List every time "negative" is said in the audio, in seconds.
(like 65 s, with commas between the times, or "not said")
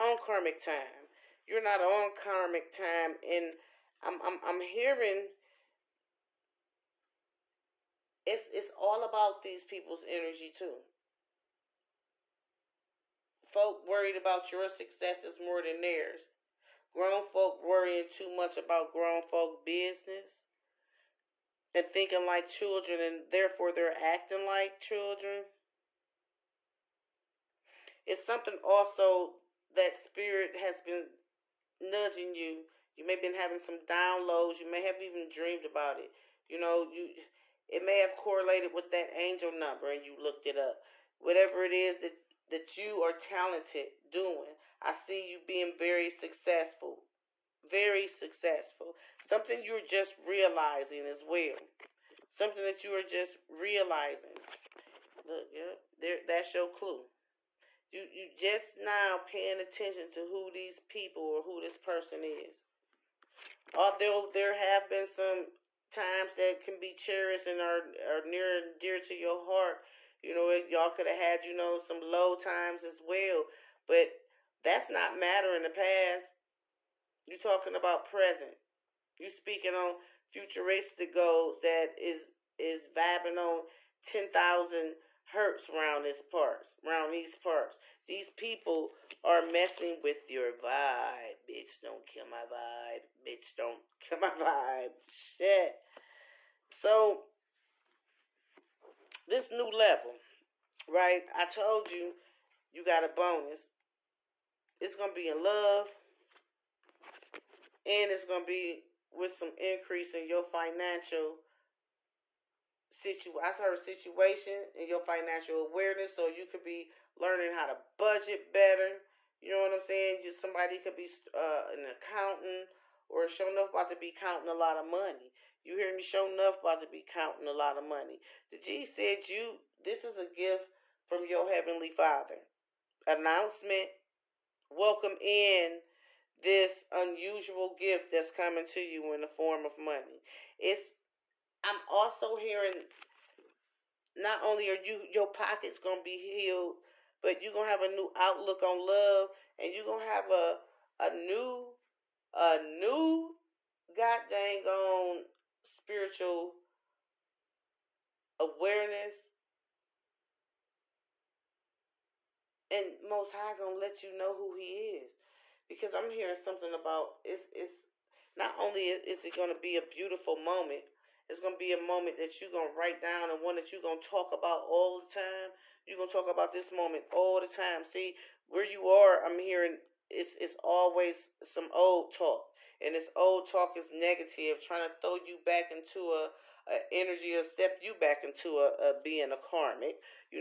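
183 s.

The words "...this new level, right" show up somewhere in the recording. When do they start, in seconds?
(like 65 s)
99 s.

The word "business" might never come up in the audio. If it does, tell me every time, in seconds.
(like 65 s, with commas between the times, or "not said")
19 s.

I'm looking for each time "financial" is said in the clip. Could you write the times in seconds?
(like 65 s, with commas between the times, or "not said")
110 s, 114 s.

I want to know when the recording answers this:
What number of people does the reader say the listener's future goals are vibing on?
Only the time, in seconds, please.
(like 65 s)
84 s.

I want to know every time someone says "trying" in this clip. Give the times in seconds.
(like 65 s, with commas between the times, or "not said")
184 s.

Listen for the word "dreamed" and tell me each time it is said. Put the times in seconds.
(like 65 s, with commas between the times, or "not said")
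35 s.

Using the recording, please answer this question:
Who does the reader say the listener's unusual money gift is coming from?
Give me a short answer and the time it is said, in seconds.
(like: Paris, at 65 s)
heavenly father, at 131 s.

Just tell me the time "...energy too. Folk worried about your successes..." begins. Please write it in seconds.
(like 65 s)
10 s.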